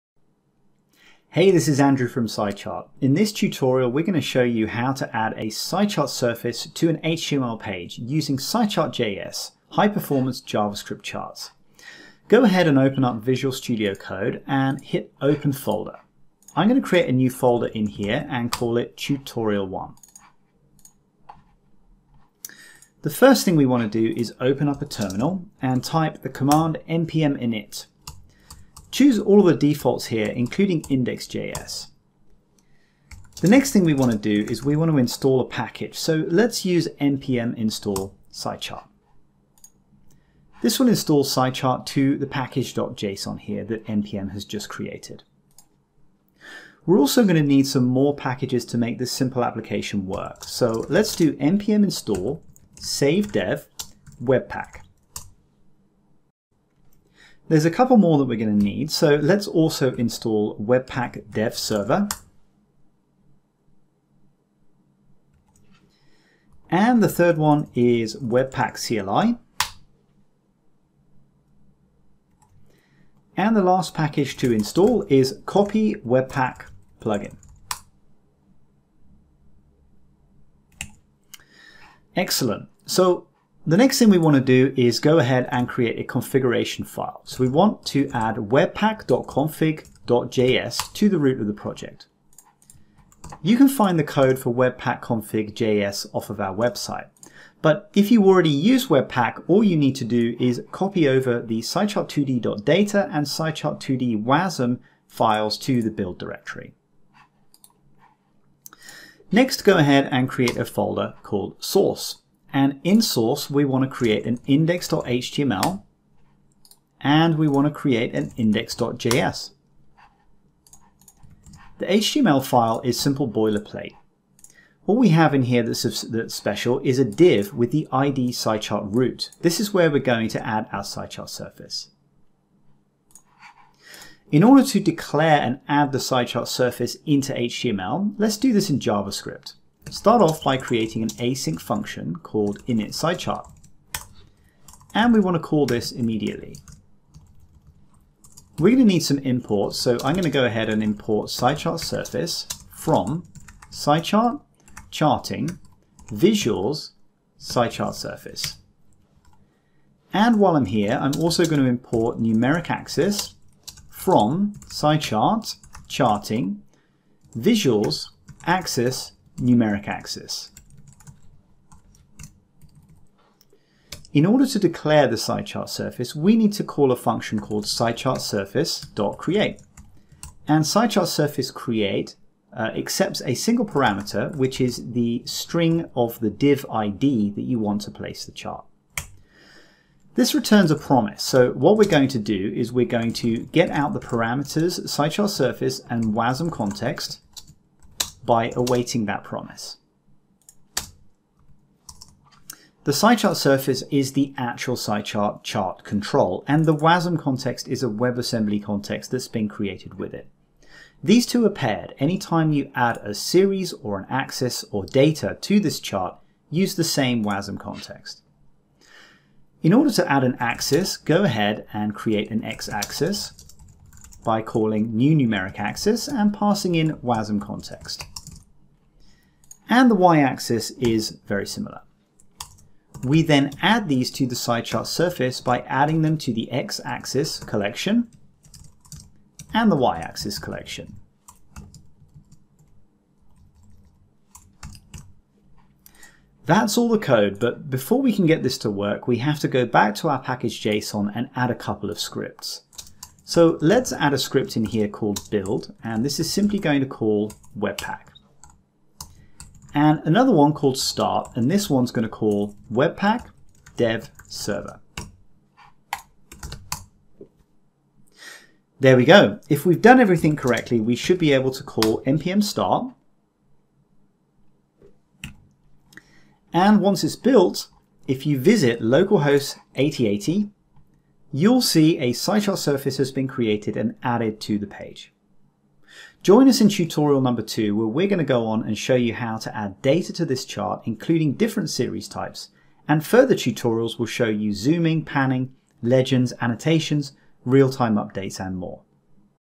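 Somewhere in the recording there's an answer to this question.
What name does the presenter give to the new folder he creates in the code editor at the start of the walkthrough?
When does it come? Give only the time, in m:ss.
0:18.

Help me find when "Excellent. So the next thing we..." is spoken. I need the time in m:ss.
1:22.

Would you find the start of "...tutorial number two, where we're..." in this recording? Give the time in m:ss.
4:46.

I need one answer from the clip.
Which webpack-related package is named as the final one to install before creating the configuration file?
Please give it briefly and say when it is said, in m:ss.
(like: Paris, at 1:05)
Copy Webpack plugin, at 1:15.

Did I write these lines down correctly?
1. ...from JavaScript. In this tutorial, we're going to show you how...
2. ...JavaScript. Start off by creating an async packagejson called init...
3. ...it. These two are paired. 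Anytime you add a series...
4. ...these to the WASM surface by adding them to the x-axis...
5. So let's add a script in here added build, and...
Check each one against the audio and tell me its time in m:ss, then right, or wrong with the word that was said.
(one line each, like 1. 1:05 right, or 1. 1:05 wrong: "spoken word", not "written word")
1. 0:02 wrong: "SciChart", not "JavaScript"
2. 2:18 wrong: "function", not "packagejson"
3. 3:30 right
4. 3:53 wrong: "SciChart", not "WASM"
5. 4:13 wrong: "called", not "added".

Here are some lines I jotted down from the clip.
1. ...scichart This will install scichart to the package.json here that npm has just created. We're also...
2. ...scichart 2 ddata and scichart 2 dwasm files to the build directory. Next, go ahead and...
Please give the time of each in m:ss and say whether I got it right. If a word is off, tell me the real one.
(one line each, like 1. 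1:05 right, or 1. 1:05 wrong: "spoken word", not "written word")
1. 0:38 right
2. 1:41 right.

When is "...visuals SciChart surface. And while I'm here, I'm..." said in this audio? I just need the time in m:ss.
2:36.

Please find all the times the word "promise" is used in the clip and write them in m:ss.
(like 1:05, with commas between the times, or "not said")
3:10, 3:19.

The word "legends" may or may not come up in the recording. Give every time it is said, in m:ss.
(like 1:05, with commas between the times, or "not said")
4:55.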